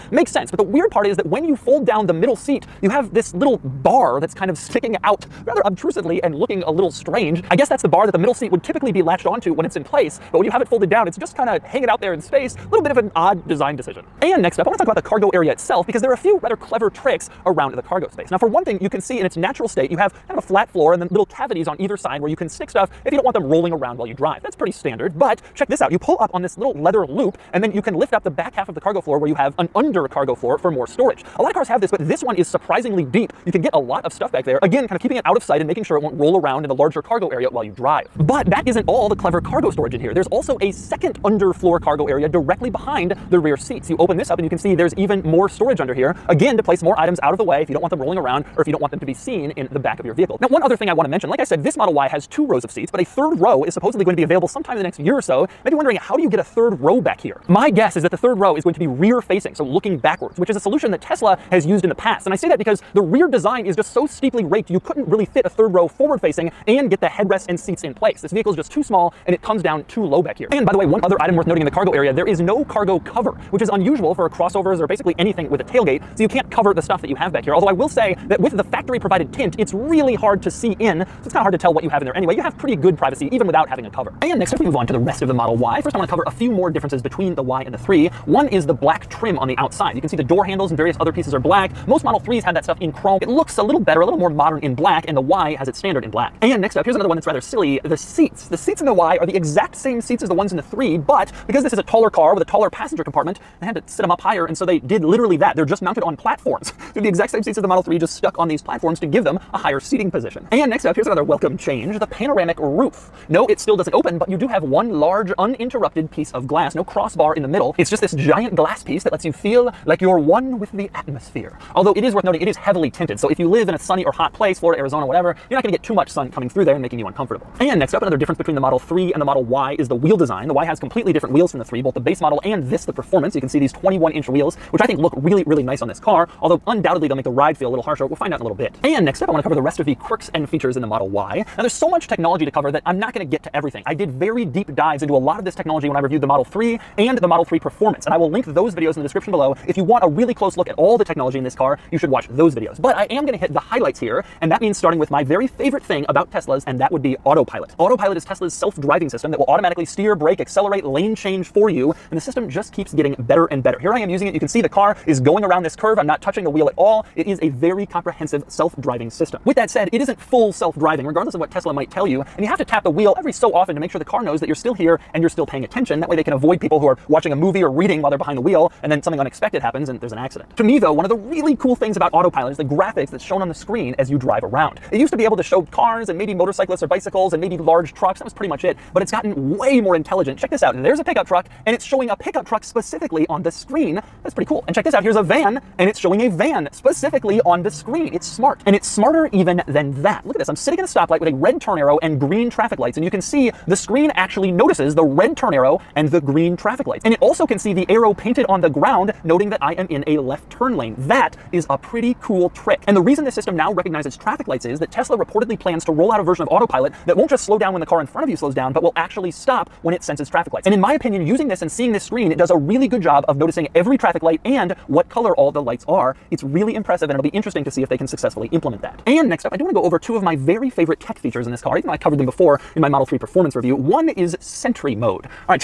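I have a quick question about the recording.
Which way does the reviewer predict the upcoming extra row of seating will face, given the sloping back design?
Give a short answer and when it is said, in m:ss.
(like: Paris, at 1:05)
rear facing, at 0:58.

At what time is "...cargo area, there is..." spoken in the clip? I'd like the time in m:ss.
1:11.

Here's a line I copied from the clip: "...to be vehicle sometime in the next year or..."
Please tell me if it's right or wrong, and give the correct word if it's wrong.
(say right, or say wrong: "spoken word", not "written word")
wrong: "available", not "vehicle".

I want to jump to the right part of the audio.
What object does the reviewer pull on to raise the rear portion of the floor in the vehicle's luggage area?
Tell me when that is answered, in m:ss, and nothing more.
0:26.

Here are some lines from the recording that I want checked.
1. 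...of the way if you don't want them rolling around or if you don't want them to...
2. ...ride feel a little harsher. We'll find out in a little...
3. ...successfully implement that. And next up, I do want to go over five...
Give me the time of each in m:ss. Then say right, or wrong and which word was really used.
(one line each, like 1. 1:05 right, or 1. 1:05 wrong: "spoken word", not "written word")
1. 0:47 right
2. 2:17 right
3. 3:48 wrong: "two", not "five".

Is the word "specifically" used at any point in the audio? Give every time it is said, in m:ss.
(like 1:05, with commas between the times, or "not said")
3:12, 3:16.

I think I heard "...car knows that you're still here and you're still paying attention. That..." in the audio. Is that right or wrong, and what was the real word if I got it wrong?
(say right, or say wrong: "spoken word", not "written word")
right.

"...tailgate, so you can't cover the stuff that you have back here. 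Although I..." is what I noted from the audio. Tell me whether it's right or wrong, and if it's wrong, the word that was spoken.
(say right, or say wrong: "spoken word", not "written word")
right.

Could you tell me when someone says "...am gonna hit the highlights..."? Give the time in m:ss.
2:33.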